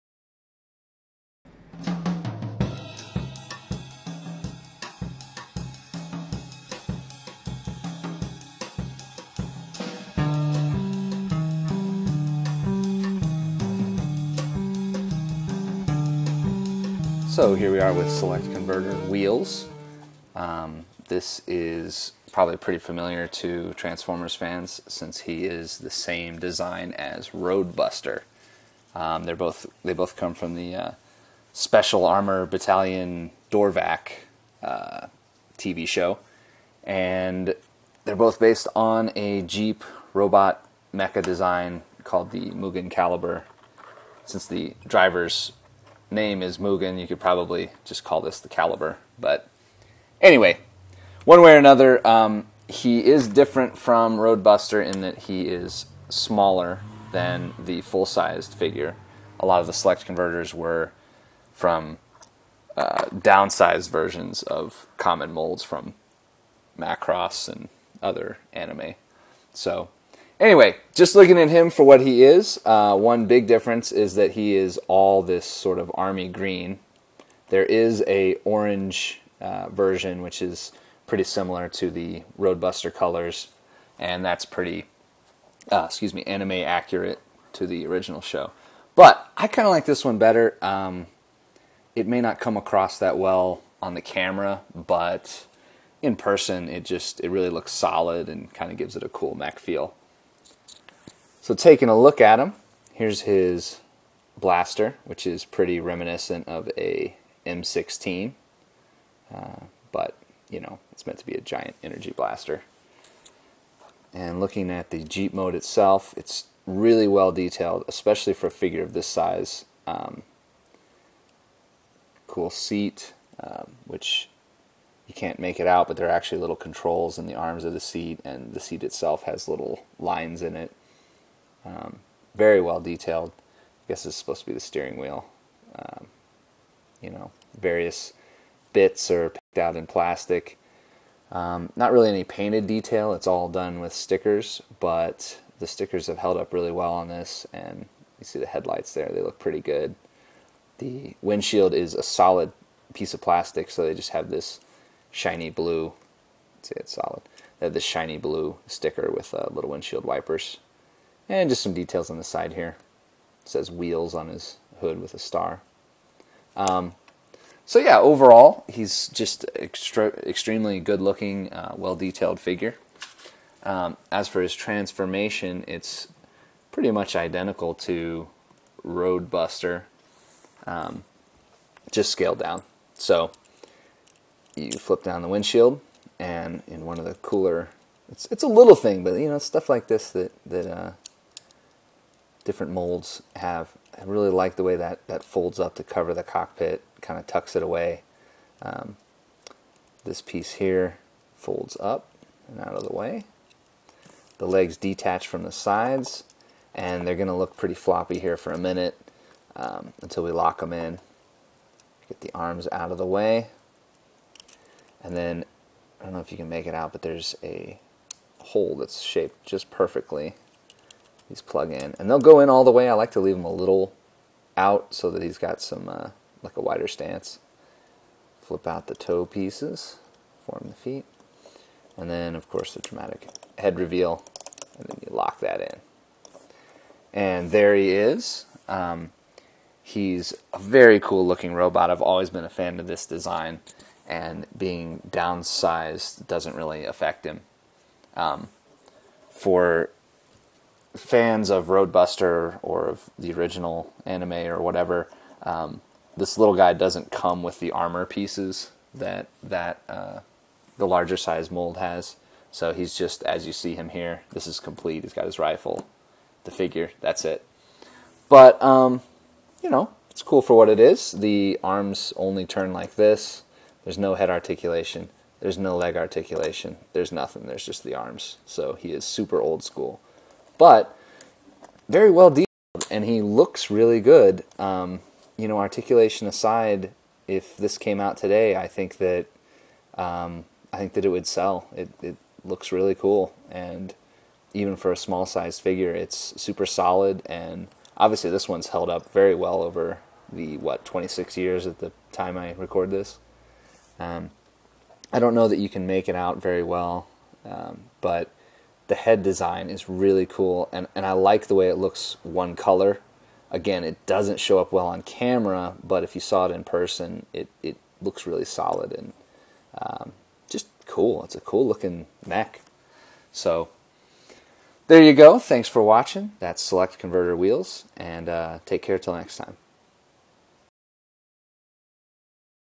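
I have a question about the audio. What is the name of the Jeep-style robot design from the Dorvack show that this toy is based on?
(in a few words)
Mugen Calibur.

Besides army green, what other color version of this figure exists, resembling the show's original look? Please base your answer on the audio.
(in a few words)
Orange.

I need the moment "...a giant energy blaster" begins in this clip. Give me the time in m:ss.
1:51.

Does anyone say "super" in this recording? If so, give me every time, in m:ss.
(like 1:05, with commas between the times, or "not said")
4:39, 4:56.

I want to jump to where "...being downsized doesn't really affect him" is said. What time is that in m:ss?
4:04.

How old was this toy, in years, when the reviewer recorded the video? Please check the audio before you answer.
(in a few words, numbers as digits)
26.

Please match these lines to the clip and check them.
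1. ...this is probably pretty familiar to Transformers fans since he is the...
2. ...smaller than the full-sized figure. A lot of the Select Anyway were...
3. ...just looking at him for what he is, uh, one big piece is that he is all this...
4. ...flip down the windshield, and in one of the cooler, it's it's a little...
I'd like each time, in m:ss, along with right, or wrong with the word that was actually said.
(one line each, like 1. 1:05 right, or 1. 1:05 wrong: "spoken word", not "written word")
1. 0:21 right
2. 0:56 wrong: "Convertors", not "Anyway"
3. 1:10 wrong: "difference", not "piece"
4. 3:04 right.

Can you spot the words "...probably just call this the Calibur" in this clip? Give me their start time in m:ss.
0:47.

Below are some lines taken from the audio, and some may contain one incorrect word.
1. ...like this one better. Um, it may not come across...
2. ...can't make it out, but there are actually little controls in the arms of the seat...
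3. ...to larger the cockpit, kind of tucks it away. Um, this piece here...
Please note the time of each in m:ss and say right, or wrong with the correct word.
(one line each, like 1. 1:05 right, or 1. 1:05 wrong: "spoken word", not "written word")
1. 1:29 right
2. 2:05 right
3. 3:15 wrong: "cover", not "larger".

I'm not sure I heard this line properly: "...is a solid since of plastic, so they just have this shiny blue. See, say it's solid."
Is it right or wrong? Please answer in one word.
wrong.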